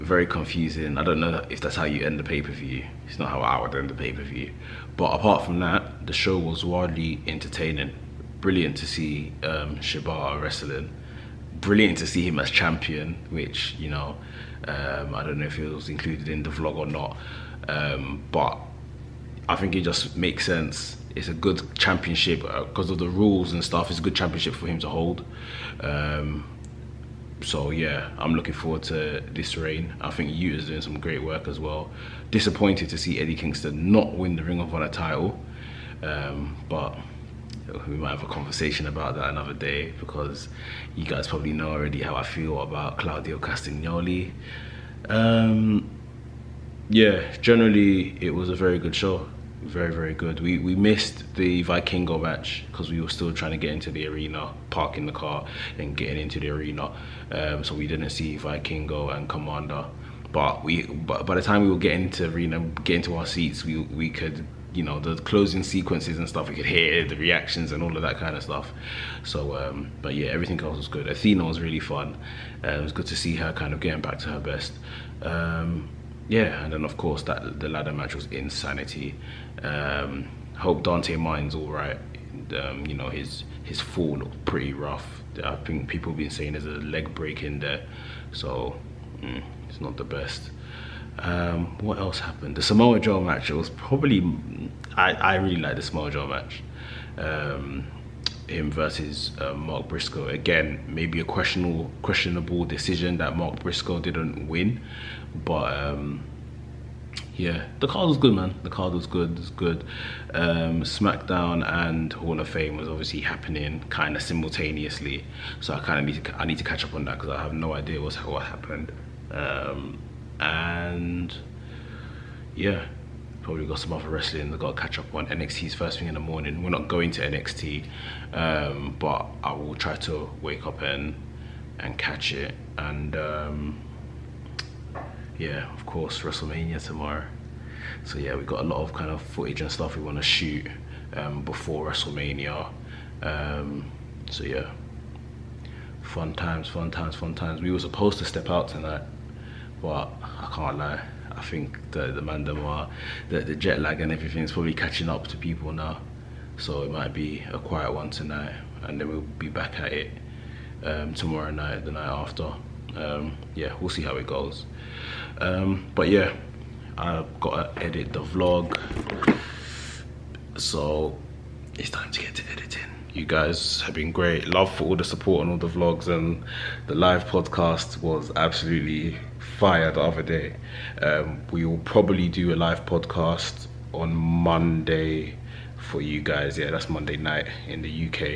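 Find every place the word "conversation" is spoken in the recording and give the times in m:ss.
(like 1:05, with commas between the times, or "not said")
0:38.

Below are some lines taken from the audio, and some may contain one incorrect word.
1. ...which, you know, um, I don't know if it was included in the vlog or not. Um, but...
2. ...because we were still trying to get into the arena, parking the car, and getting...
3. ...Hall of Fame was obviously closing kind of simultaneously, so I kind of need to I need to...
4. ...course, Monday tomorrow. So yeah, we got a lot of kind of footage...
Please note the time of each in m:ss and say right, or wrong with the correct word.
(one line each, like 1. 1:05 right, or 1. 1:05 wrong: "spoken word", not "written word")
1. 0:13 right
2. 0:52 right
3. 1:52 wrong: "happening", not "closing"
4. 2:15 wrong: "WrestleMania", not "Monday".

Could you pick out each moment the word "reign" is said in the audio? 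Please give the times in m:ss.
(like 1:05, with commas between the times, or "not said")
0:29.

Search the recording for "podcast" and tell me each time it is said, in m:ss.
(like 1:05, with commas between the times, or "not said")
2:57, 3:02.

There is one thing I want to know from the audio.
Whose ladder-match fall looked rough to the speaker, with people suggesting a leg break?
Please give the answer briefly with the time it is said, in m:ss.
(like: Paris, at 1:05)
Dante Martin, at 1:20.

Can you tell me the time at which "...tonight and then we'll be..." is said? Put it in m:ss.
2:38.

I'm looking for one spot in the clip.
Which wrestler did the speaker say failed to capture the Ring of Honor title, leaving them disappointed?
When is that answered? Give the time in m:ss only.
0:33.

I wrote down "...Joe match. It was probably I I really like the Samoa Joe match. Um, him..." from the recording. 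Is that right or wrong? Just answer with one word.
right.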